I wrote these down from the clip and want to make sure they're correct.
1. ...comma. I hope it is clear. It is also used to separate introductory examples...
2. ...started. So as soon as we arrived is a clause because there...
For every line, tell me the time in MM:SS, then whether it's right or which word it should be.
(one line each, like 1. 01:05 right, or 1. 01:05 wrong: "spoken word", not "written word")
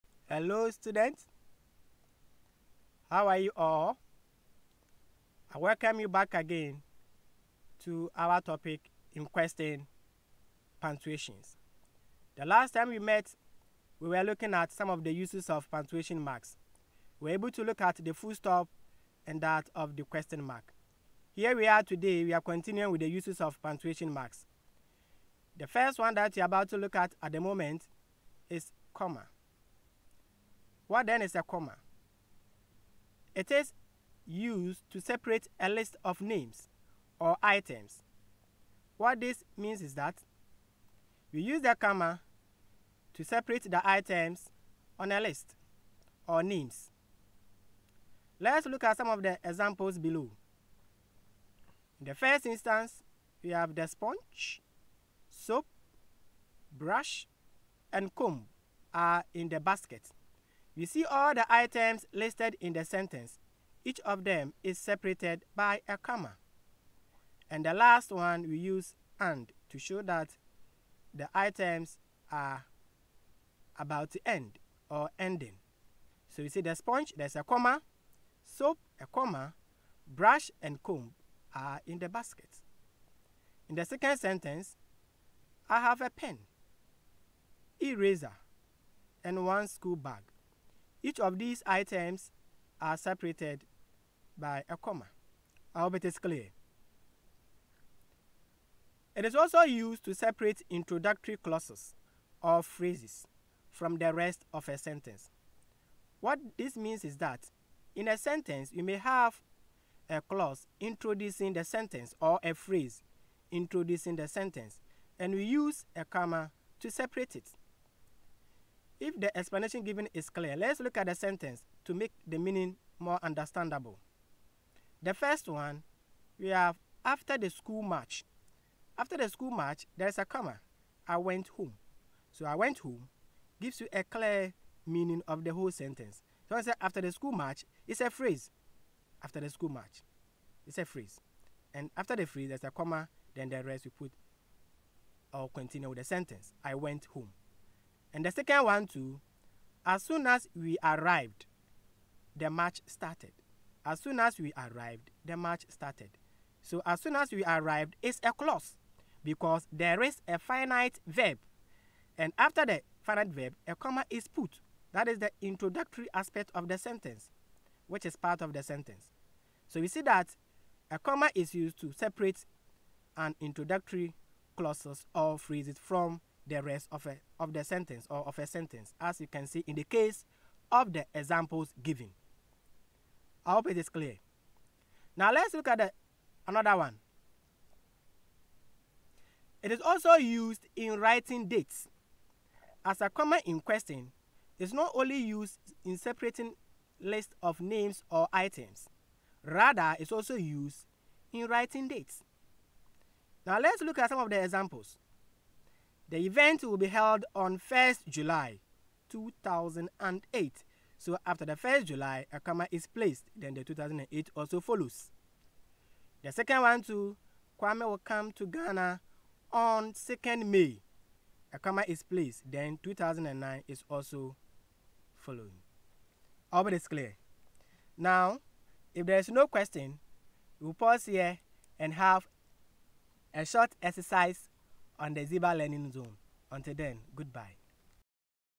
1. 01:34 wrong: "clauses", not "examples"
2. 02:35 right.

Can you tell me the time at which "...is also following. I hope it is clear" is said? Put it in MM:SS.
03:43.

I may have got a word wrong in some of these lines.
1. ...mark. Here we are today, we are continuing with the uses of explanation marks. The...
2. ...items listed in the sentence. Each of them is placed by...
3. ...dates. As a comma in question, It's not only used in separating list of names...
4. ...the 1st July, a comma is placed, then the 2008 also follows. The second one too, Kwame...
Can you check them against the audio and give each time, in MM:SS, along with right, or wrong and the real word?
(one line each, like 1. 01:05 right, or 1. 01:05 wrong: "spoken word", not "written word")
1. 00:20 wrong: "punctuation", not "explanation"
2. 01:01 wrong: "separated", not "placed"
3. 03:11 right
4. 03:31 right.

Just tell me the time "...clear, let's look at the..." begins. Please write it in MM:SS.
02:00.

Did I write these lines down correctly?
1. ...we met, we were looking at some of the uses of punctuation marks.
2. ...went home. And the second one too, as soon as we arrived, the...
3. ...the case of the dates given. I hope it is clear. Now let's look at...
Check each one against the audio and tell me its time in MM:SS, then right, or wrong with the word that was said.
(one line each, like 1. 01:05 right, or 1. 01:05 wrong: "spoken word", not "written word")
1. 00:12 right
2. 02:26 right
3. 02:59 wrong: "examples", not "dates".